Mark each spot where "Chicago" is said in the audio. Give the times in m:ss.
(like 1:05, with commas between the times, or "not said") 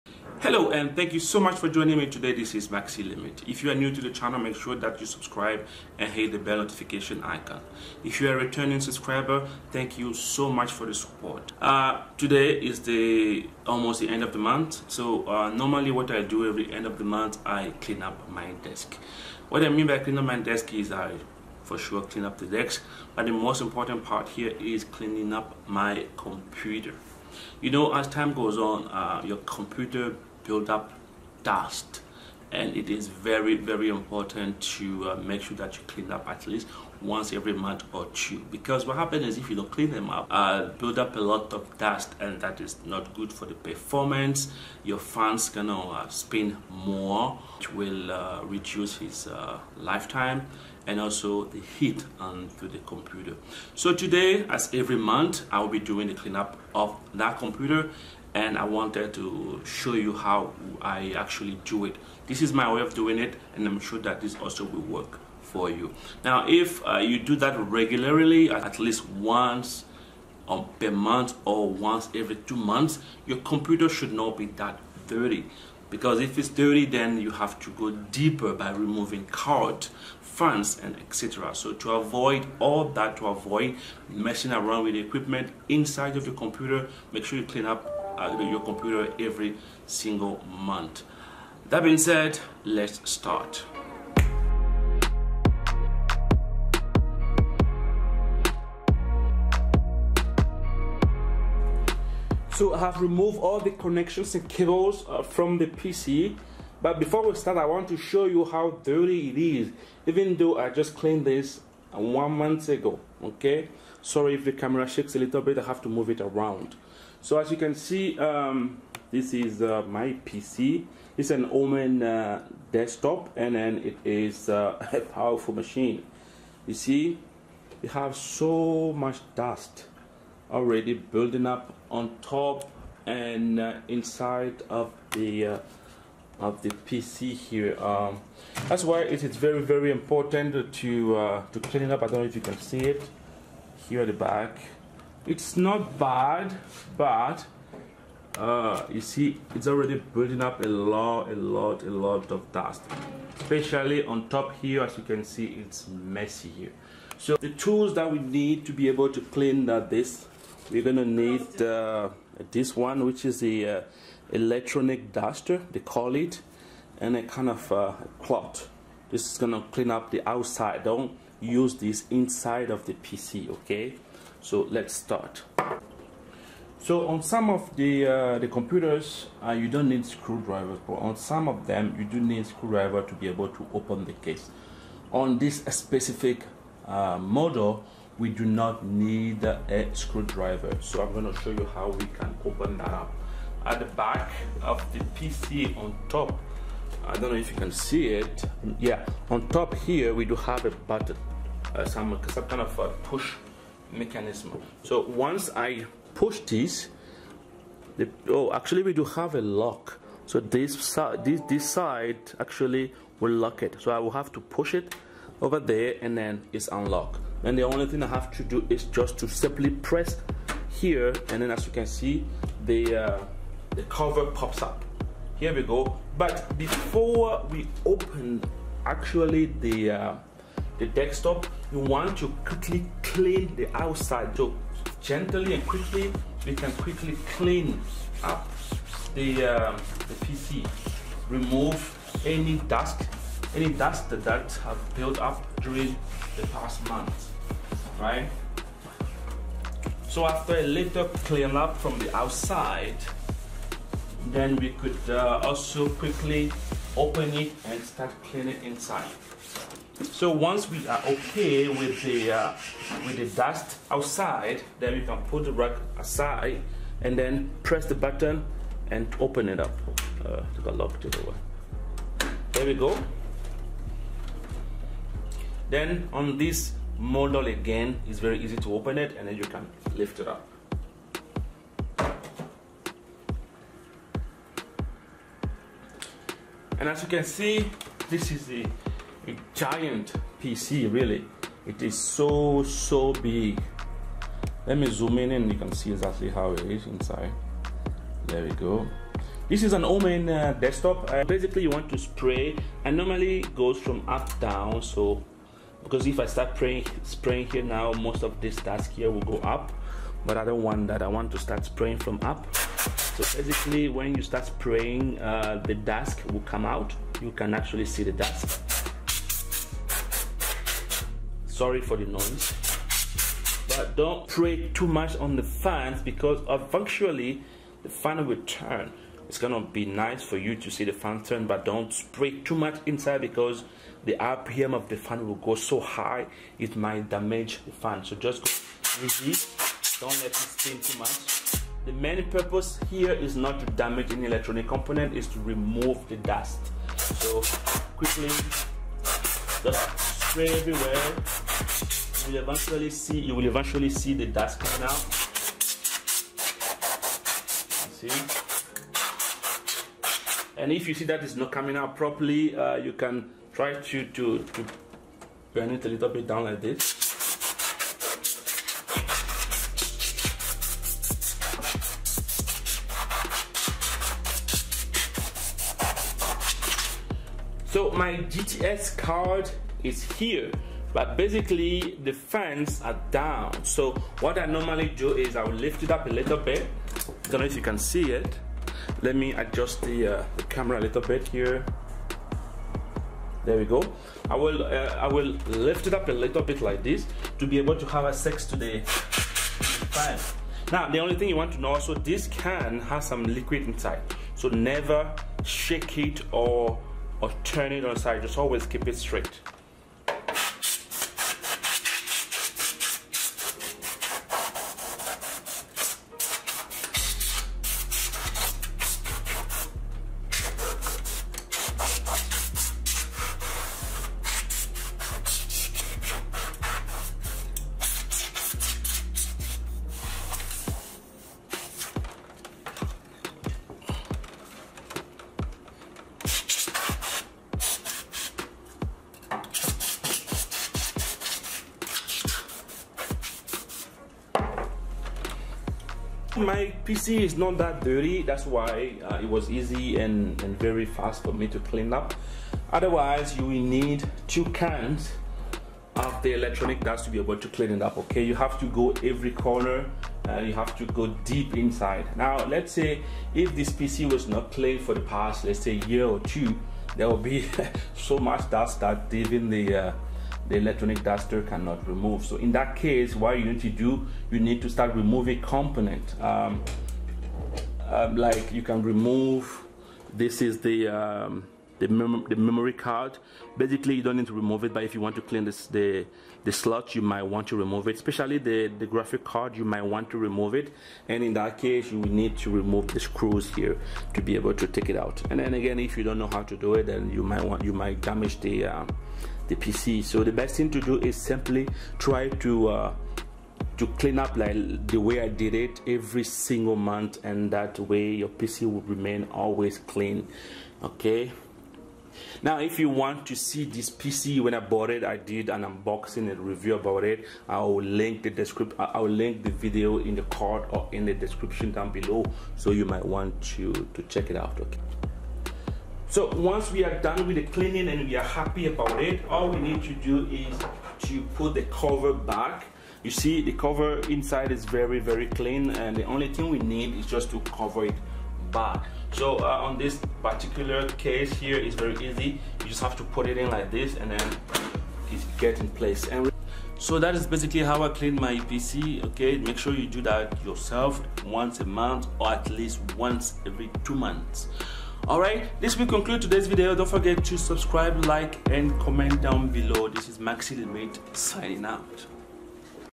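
not said.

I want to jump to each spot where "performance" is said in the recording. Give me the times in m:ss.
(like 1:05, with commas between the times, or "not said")
0:43.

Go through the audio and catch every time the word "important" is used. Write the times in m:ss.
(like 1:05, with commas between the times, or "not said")
0:23, 0:33, 2:19.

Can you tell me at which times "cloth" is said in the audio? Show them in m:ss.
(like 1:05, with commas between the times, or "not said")
2:48.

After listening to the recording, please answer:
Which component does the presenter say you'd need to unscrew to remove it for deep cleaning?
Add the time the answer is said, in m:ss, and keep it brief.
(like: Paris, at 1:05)
graphic card, at 8:08.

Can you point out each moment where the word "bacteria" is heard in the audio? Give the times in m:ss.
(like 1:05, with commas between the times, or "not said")
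not said.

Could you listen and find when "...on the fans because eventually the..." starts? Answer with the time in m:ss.
5:25.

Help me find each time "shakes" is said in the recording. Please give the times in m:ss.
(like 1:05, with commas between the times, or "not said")
1:54, 6:45.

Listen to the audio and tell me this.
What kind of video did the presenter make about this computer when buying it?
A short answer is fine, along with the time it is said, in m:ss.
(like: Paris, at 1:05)
unboxing and review, at 8:35.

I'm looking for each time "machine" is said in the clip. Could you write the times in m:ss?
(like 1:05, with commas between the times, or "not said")
2:05.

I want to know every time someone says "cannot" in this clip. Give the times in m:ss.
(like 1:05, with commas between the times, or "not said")
7:51.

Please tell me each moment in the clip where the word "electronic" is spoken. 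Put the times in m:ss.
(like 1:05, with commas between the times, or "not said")
2:44, 5:44, 7:36, 7:50.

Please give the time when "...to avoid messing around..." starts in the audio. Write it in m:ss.
1:23.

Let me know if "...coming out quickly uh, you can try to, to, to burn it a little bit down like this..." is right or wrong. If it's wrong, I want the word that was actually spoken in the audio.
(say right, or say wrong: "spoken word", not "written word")
wrong: "properly", not "quickly".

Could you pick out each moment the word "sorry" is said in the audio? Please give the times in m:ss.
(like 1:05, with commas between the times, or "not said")
1:54, 5:21.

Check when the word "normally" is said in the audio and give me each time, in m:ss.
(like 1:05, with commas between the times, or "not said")
0:15, 5:02, 6:24.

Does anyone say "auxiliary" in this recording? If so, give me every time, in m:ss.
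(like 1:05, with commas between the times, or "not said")
not said.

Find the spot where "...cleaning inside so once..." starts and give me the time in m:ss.
4:18.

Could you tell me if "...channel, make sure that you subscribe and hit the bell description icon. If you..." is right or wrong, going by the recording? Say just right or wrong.
wrong.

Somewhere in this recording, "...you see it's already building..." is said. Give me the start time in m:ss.
2:28.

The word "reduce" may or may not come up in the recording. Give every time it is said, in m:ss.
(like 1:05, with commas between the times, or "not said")
0:48.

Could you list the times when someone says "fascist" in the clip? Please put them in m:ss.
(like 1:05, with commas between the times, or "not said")
not said.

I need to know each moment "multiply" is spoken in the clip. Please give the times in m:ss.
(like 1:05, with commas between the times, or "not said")
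not said.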